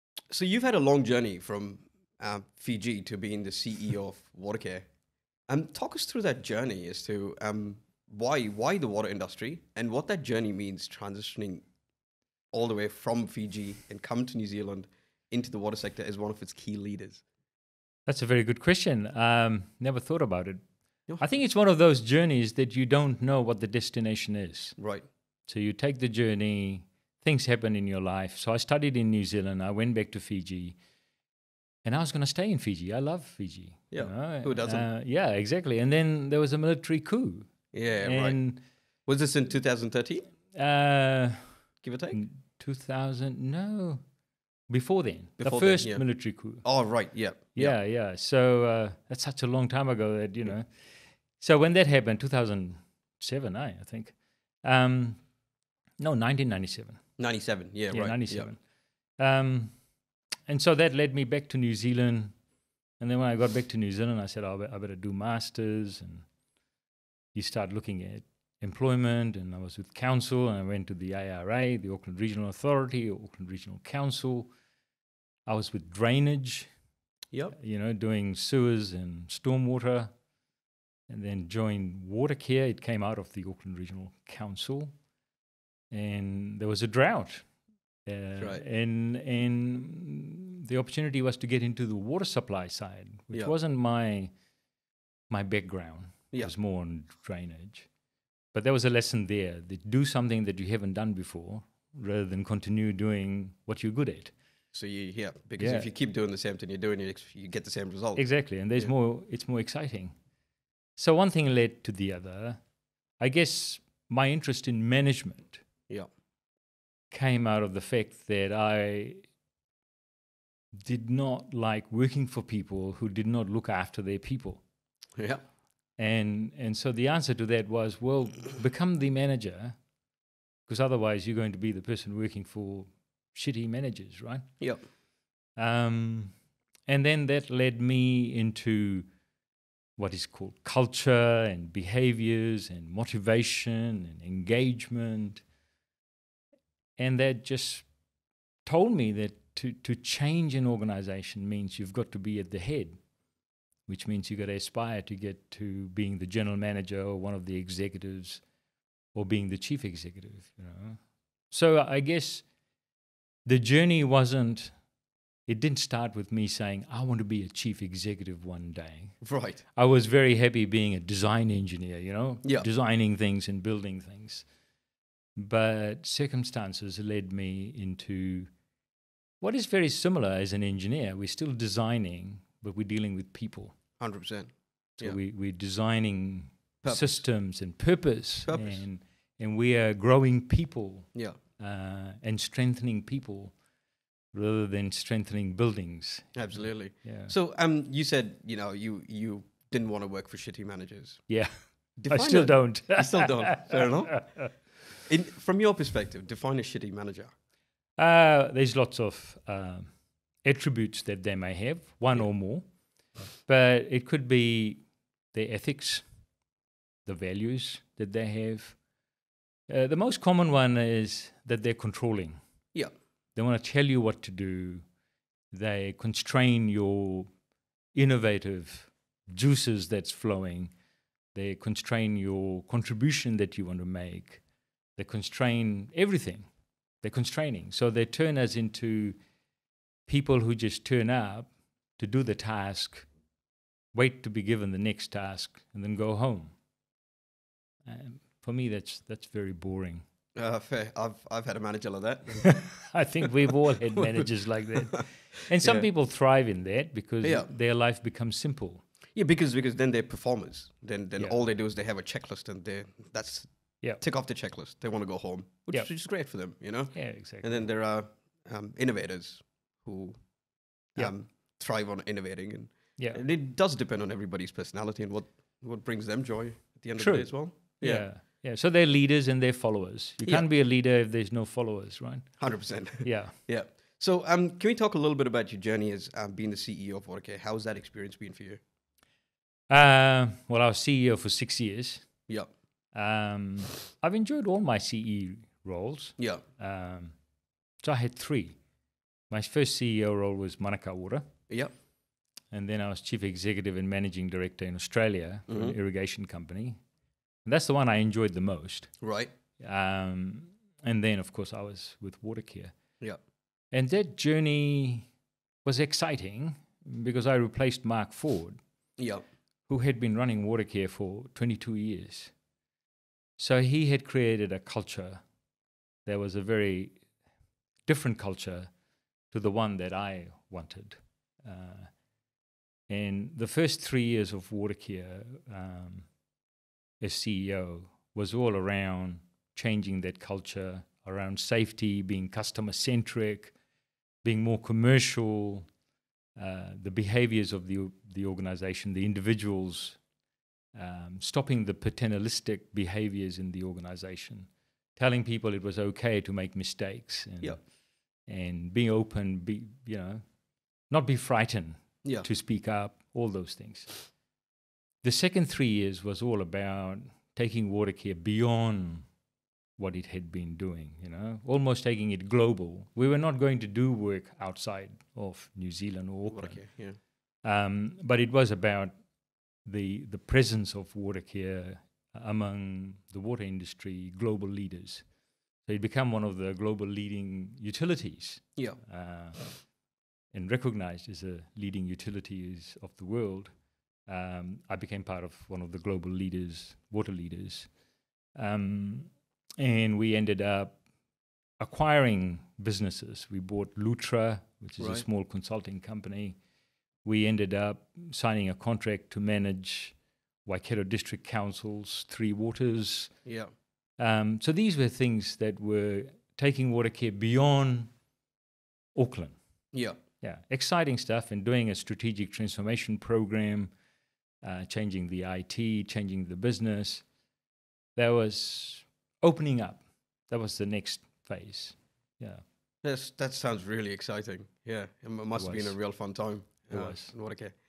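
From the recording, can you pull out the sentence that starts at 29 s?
I went back to Fiji, and I was going to stay in Fiji.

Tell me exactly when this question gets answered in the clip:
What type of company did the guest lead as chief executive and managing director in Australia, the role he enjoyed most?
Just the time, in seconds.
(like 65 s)
305 s.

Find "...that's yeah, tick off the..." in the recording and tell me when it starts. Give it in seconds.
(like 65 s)
263 s.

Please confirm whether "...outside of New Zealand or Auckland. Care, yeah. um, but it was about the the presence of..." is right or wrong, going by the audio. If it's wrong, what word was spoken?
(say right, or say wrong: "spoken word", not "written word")
right.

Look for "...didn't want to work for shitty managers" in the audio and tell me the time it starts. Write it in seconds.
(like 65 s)
199 s.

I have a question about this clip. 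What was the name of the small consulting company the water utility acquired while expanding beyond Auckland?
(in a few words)
Lutra.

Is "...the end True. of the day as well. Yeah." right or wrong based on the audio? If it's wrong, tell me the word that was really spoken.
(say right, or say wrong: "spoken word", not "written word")
right.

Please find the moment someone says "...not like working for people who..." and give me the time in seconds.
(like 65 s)
121 s.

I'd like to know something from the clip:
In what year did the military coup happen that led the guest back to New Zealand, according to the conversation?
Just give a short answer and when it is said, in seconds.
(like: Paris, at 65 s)
1997, at 57 s.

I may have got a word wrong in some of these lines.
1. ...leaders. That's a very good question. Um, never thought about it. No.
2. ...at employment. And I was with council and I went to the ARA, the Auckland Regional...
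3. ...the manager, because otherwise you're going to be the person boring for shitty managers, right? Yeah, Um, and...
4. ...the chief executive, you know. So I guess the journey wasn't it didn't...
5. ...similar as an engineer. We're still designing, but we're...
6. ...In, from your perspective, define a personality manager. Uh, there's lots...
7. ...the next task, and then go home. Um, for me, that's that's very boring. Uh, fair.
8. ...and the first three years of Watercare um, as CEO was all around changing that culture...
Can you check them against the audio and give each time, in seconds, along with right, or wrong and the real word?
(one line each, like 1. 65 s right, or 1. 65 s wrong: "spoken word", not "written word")
1. 16 s right
2. 68 s right
3. 128 s wrong: "working", not "boring"
4. 159 s right
5. 179 s right
6. 205 s wrong: "shitty", not "personality"
7. 244 s right
8. 332 s right.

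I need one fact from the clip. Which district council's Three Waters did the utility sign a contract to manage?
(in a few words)
Waikato District Council.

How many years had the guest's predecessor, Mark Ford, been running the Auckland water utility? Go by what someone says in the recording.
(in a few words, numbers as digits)
22 years.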